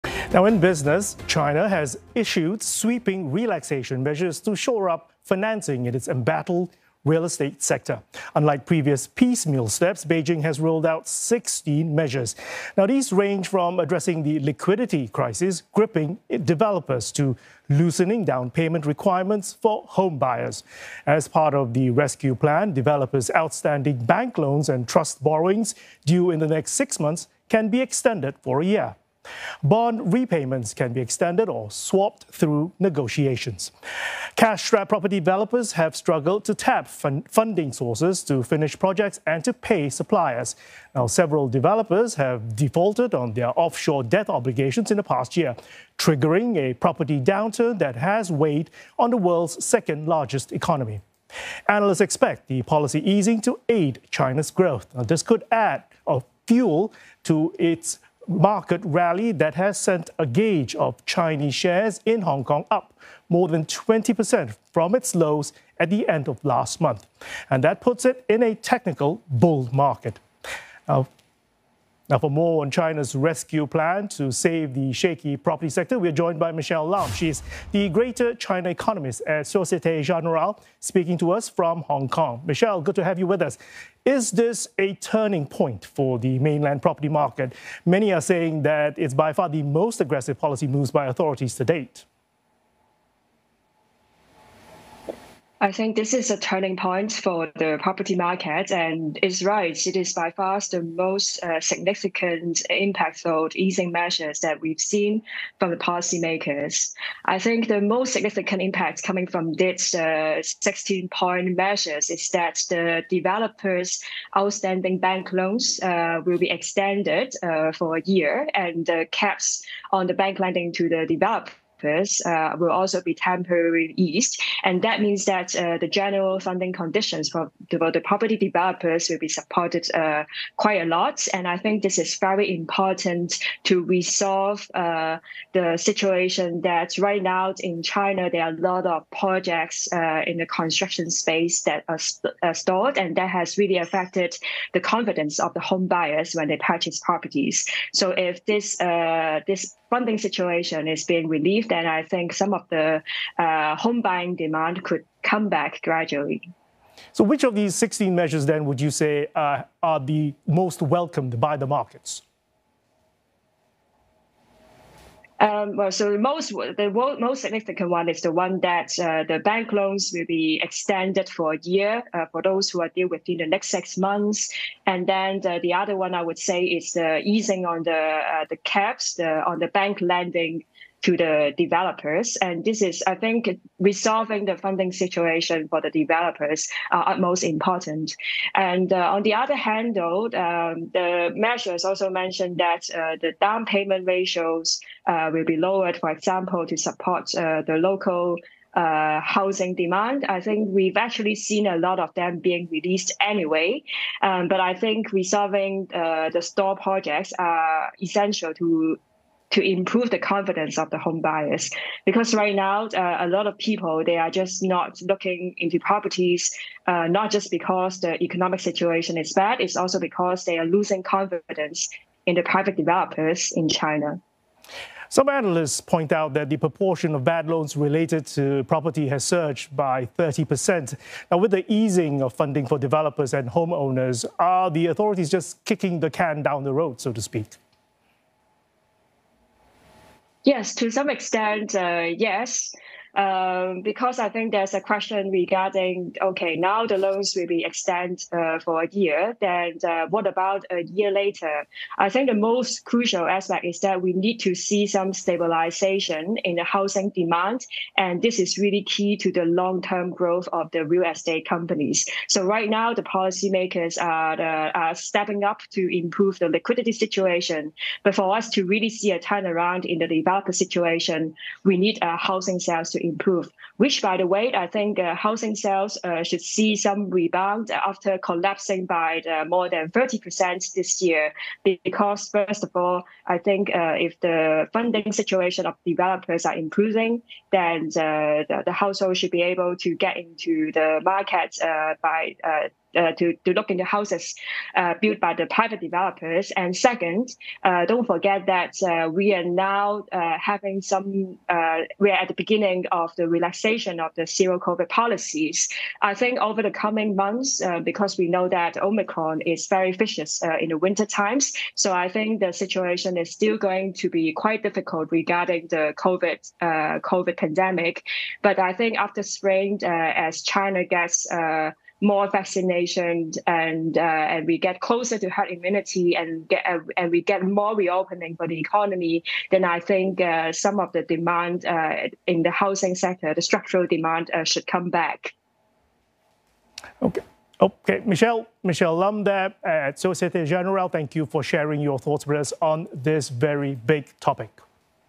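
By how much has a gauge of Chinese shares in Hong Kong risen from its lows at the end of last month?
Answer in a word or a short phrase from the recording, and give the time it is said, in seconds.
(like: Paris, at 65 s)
more than 20%, at 63 s.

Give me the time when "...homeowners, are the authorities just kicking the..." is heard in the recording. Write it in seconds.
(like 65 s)
233 s.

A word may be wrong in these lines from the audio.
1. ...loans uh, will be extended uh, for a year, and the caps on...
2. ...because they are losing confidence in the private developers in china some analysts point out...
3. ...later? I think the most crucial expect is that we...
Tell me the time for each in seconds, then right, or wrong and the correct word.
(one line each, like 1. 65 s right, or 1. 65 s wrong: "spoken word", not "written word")
1. 115 s right
2. 219 s right
3. 251 s wrong: "aspect", not "expect".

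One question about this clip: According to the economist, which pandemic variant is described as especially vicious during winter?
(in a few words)
Omicron.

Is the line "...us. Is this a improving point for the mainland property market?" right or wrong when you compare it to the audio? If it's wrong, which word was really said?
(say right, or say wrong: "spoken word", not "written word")
wrong: "turning", not "improving".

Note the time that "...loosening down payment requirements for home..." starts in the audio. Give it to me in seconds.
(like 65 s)
17 s.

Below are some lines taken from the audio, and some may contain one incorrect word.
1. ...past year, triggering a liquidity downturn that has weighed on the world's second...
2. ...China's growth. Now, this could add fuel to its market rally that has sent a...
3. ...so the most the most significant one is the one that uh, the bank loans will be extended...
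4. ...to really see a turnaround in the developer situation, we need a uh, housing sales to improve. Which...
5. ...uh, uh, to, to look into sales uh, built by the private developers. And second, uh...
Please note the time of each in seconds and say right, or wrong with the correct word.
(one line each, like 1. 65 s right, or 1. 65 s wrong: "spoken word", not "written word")
1. 45 s wrong: "property", not "liquidity"
2. 54 s right
3. 165 s right
4. 268 s right
5. 292 s wrong: "houses", not "sales".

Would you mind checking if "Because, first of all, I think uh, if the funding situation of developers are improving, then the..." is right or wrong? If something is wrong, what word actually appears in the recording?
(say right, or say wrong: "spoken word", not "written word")
right.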